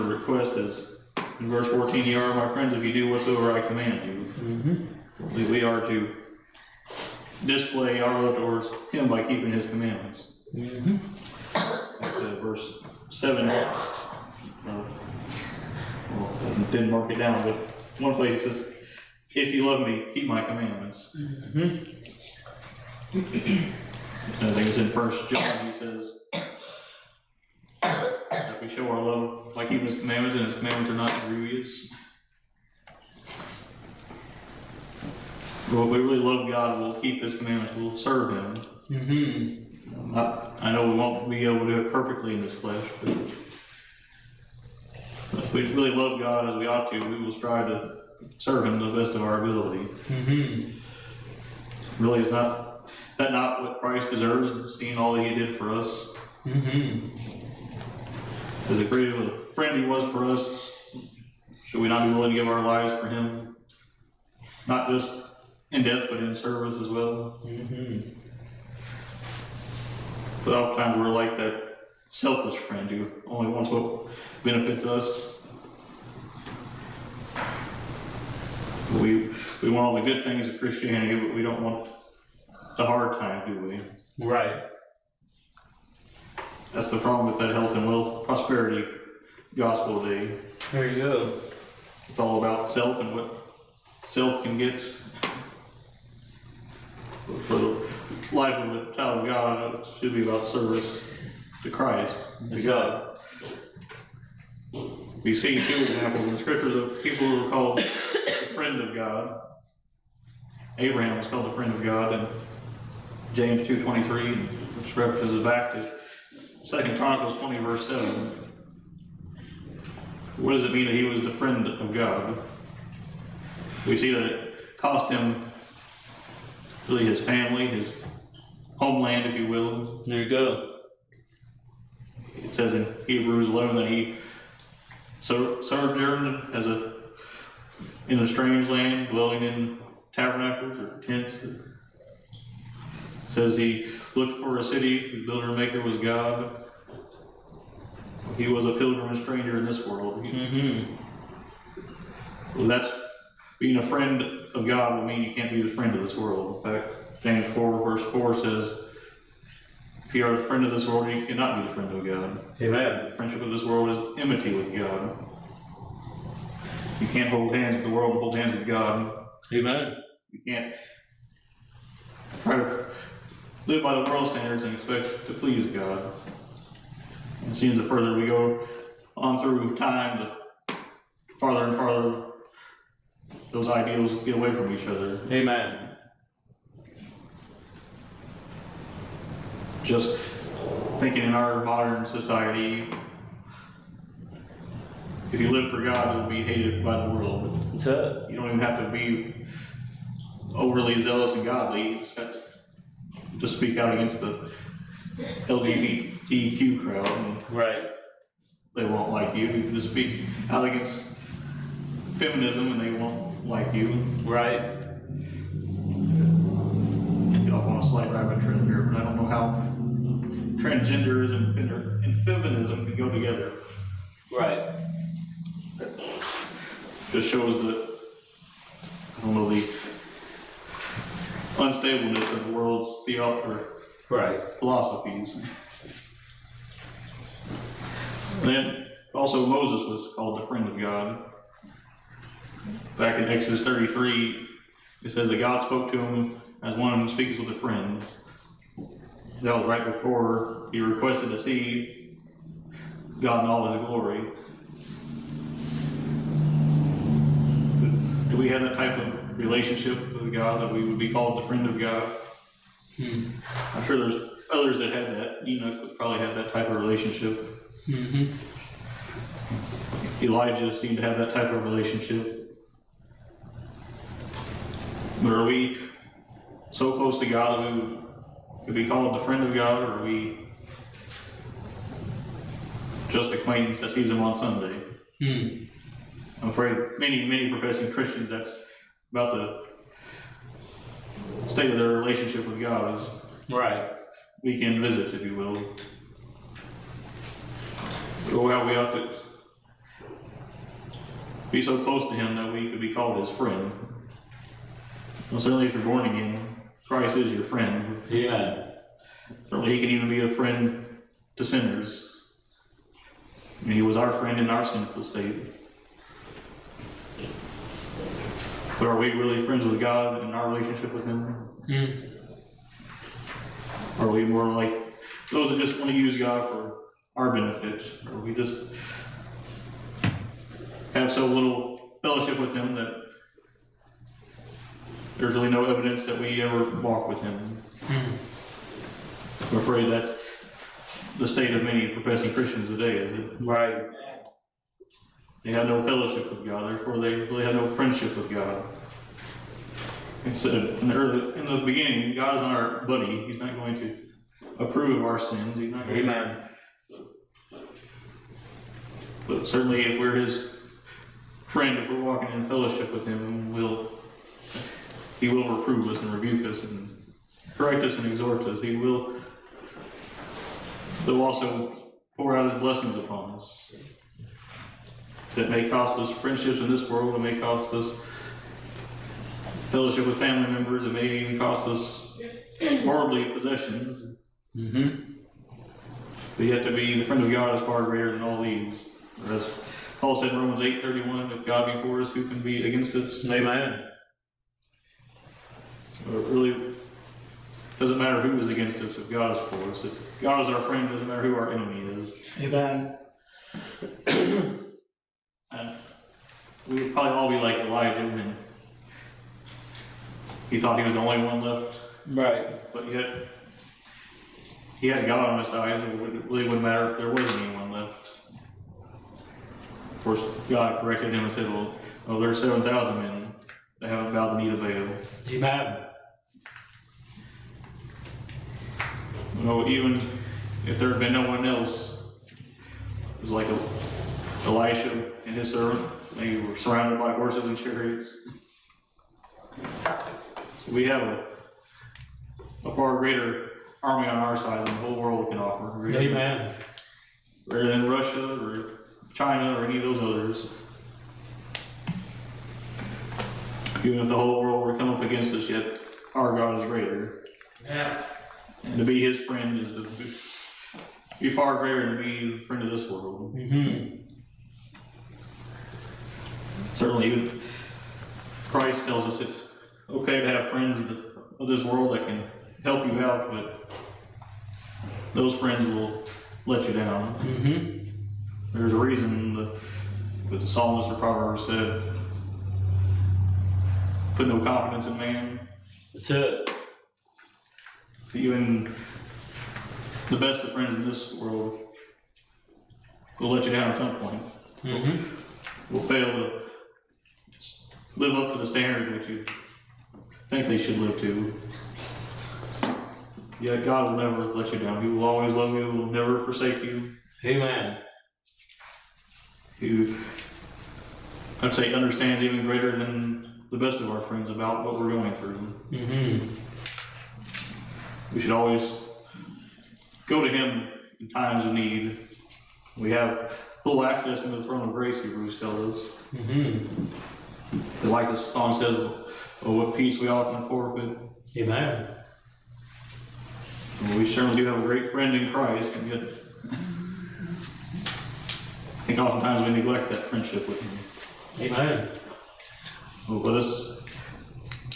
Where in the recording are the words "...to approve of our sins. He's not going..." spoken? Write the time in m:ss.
5:53.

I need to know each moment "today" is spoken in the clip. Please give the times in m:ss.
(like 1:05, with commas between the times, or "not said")
1:30, 5:42.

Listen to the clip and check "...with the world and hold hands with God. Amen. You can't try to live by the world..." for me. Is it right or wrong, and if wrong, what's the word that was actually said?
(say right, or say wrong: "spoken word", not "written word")
right.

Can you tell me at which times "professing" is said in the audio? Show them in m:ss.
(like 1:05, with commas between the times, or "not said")
4:47, 5:41.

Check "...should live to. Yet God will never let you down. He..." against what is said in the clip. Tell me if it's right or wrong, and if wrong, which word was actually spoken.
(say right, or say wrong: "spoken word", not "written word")
right.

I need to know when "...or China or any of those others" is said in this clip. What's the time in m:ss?
7:28.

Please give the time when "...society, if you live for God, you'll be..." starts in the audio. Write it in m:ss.
3:12.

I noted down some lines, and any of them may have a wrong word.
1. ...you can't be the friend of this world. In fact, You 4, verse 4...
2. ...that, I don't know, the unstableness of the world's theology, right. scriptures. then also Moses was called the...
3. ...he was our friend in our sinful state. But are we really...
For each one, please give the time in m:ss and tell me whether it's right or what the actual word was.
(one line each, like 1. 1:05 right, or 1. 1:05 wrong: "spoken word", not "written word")
1. 2:35 wrong: "James", not "You"
2. 3:47 wrong: "philosophies", not "scriptures"
3. 5:13 right.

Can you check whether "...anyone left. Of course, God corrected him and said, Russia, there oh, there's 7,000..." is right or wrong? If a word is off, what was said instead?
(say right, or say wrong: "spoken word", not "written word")
wrong: "Well", not "Russia".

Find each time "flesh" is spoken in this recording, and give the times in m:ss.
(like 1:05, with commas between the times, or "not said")
0:42.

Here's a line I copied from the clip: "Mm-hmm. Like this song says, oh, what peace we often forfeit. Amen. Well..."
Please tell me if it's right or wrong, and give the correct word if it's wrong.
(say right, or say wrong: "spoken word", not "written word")
right.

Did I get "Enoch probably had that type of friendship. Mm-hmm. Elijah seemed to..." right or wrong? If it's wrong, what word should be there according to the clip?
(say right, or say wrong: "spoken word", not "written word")
wrong: "relationship", not "friendship".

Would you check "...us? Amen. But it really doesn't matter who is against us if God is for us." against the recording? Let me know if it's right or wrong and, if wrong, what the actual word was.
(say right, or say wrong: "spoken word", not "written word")
right.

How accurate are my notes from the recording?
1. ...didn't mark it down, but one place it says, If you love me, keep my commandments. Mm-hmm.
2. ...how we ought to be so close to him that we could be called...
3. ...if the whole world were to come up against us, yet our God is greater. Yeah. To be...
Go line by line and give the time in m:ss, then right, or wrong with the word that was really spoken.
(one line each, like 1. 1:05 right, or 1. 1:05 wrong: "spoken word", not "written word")
1. 0:16 right
2. 4:58 right
3. 7:34 right.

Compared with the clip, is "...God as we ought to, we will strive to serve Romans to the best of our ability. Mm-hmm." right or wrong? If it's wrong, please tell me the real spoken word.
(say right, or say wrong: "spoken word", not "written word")
wrong: "Him", not "Romans".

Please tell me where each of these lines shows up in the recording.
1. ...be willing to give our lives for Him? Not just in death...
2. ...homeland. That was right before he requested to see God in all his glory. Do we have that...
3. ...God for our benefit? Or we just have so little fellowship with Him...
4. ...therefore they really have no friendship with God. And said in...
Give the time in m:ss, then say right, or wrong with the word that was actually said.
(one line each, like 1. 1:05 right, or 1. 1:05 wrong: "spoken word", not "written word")
1. 1:02 right
2. 4:07 wrong: "friend", not "homeland"
3. 5:26 right
4. 5:46 right.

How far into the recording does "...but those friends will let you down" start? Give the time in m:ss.
7:53.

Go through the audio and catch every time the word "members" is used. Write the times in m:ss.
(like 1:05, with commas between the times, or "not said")
6:20.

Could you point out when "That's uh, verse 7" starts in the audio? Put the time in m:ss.
0:12.